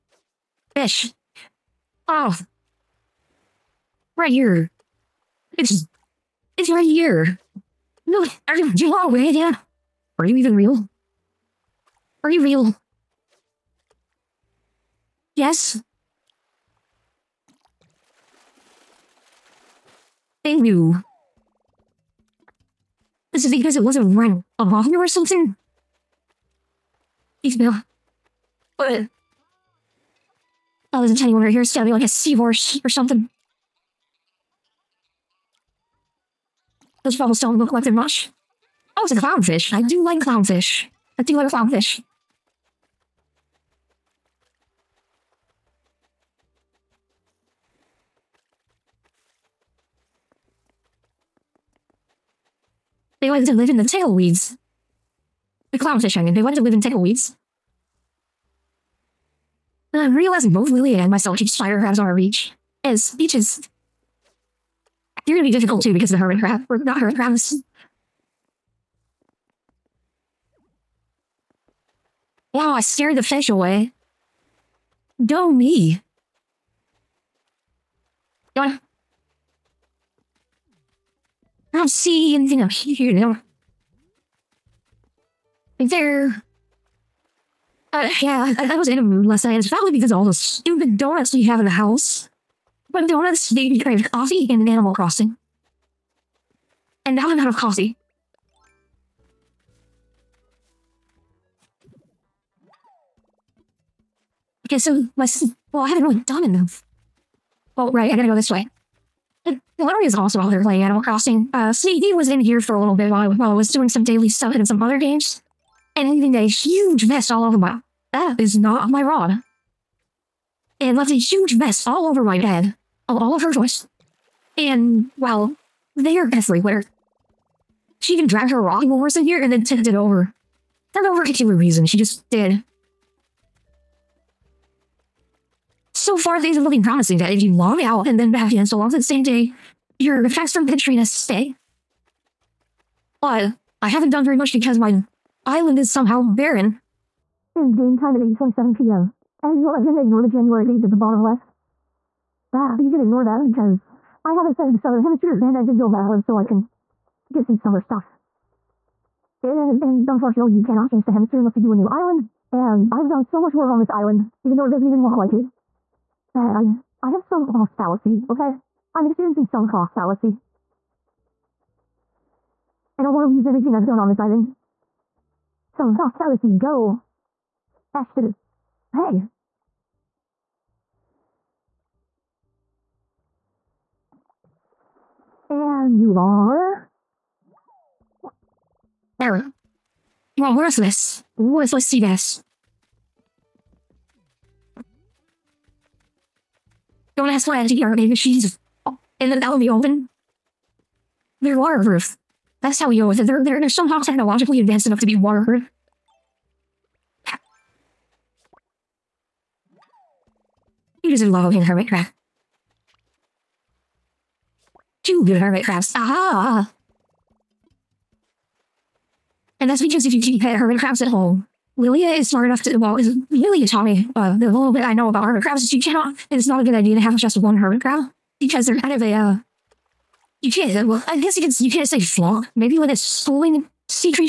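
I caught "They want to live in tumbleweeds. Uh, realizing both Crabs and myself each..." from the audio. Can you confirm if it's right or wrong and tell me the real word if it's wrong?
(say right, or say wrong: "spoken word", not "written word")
wrong: "Lily", not "Crabs".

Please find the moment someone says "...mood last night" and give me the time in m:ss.
1:29.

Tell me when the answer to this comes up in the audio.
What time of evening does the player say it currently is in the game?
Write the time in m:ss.
2:28.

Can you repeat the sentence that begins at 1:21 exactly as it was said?
I don't see anything up here.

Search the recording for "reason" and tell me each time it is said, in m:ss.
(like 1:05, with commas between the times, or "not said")
2:11.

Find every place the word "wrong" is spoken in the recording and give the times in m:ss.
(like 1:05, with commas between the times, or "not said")
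not said.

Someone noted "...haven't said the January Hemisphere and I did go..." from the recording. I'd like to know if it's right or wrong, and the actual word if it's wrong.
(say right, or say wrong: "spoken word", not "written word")
wrong: "Southern", not "January".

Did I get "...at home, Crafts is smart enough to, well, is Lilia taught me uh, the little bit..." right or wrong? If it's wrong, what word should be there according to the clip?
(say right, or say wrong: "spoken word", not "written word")
wrong: "Lilia", not "Crafts".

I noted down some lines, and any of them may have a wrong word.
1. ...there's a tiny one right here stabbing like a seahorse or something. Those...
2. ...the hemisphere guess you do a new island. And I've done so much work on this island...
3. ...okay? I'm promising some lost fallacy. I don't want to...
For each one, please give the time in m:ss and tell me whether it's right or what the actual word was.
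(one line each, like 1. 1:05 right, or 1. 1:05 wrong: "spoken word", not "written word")
1. 0:31 right
2. 2:41 wrong: "unless", not "guess"
3. 2:48 wrong: "experiencing", not "promising".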